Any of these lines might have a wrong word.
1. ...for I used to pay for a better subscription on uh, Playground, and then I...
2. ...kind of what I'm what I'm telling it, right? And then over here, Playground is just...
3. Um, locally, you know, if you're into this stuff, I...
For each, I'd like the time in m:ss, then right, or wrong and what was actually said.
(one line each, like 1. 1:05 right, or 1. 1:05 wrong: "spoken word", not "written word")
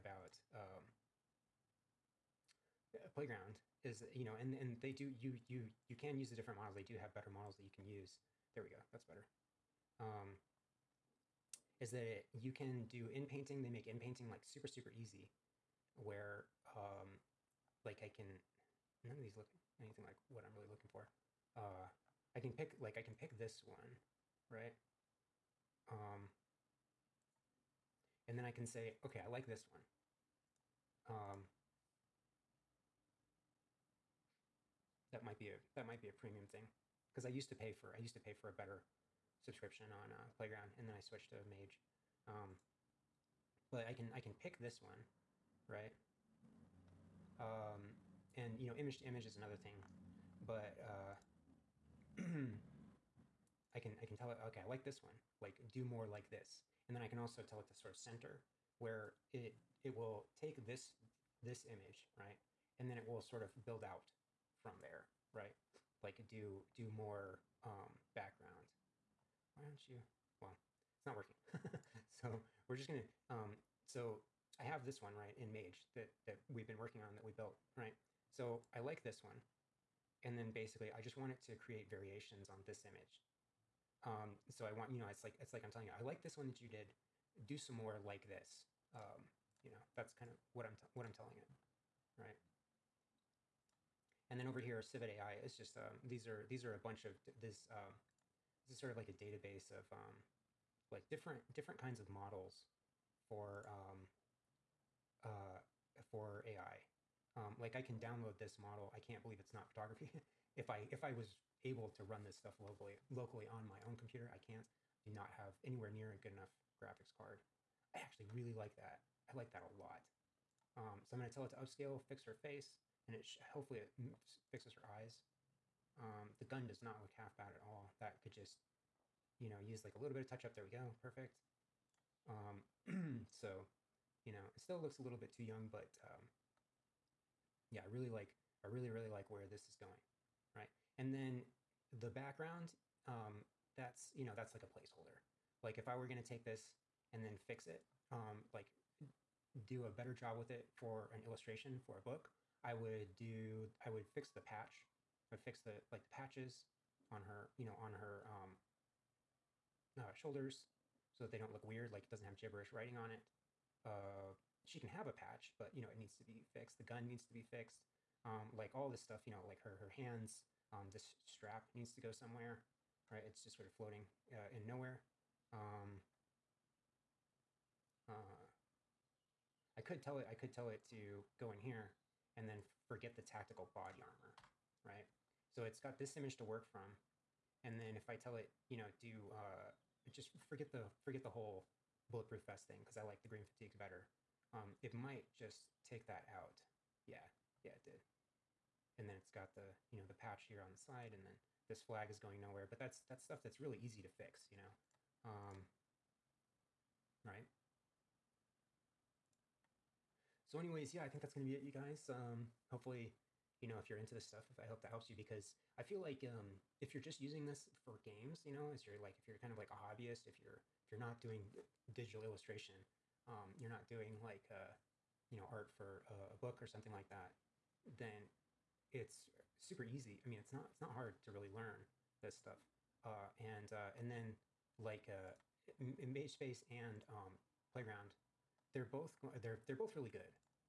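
1. 0:37 right
2. 1:30 wrong: "Civitai", not "Playground"
3. 3:32 wrong: "hopefully", not "locally".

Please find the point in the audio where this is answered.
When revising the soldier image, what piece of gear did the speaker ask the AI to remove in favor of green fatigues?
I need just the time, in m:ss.
3:03.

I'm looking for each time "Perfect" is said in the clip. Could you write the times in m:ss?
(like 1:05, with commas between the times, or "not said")
2:11.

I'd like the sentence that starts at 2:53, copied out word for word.
It's just sort of floating uh, in nowhere.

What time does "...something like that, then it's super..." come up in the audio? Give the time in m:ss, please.
3:46.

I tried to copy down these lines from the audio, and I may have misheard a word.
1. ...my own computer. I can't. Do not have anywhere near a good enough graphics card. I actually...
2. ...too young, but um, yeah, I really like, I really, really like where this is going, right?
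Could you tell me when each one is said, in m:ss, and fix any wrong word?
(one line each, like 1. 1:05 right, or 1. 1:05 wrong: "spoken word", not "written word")
1. 1:53 right
2. 2:15 right.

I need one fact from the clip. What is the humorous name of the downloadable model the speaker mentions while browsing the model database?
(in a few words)
I Can't Believe It's Not Photography.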